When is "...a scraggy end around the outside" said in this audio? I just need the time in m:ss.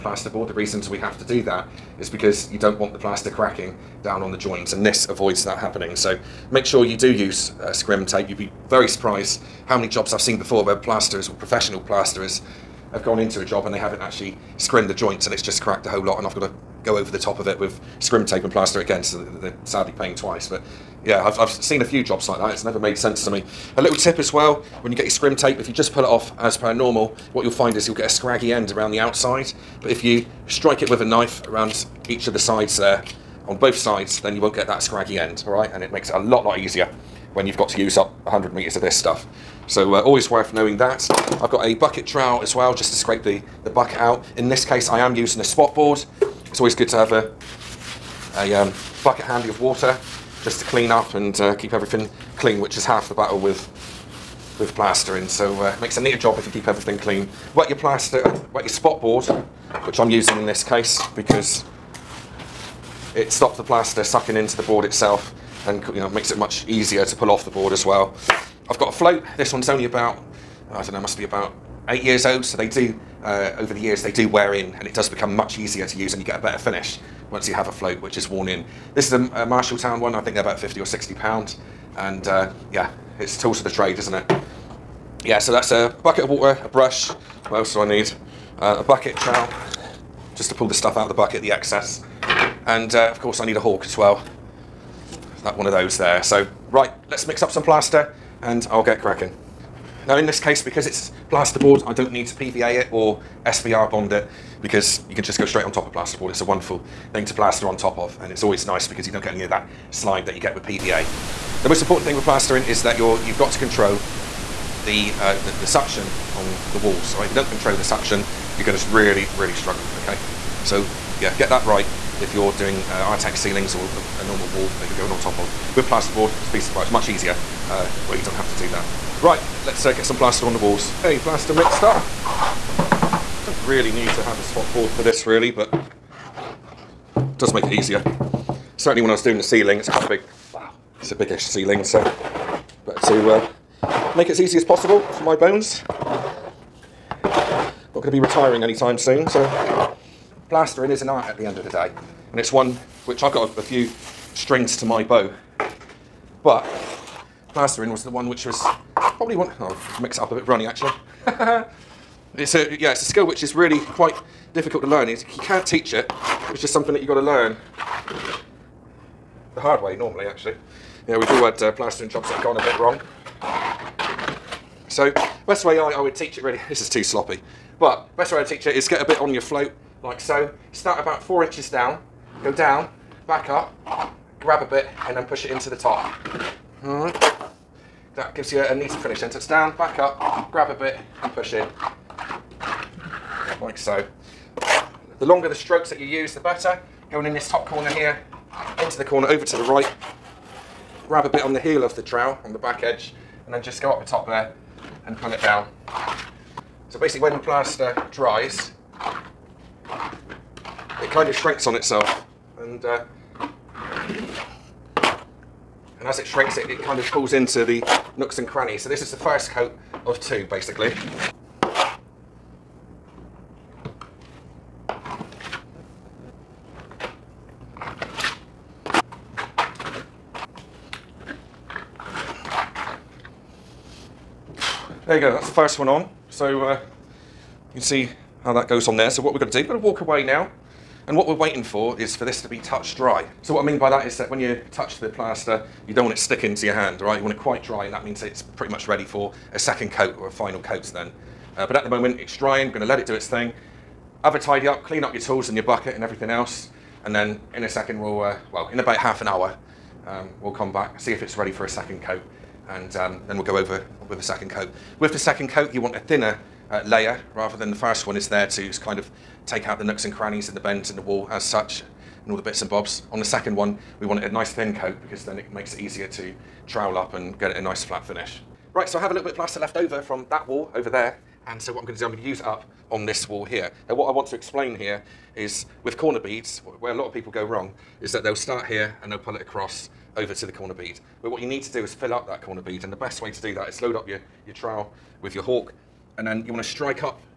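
0:28.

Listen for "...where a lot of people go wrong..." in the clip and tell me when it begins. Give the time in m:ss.
4:46.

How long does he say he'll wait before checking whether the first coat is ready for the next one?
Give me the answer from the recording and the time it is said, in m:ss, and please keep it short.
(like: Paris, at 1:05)
half an hour, at 4:18.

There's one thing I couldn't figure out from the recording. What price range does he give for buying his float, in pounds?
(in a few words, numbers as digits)
50 or 60 pounds.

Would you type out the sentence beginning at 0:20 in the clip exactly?
But yeah, I've, I've seen a few jobs like that.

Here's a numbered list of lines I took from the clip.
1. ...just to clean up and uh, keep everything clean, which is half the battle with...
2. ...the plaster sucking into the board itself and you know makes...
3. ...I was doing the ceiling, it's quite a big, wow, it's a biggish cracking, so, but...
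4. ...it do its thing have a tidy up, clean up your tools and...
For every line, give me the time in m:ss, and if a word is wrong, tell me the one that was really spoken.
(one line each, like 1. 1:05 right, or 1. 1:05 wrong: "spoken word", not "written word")
1. 0:50 right
2. 1:03 right
3. 2:19 wrong: "ceiling", not "cracking"
4. 4:12 right.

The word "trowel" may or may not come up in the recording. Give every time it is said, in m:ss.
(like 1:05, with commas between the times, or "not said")
0:42, 1:29, 3:22, 4:36, 4:54.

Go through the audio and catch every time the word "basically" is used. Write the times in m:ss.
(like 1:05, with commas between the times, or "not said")
3:26, 3:40.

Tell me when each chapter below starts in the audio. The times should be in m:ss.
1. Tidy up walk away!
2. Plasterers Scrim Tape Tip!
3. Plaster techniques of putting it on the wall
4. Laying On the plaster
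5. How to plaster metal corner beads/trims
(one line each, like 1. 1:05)
1. 4:08
2. 0:23
3. 2:57
4. 2:13
5. 4:38.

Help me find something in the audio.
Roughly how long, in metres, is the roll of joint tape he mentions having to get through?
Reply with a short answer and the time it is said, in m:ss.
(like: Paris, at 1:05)
100 meters, at 0:38.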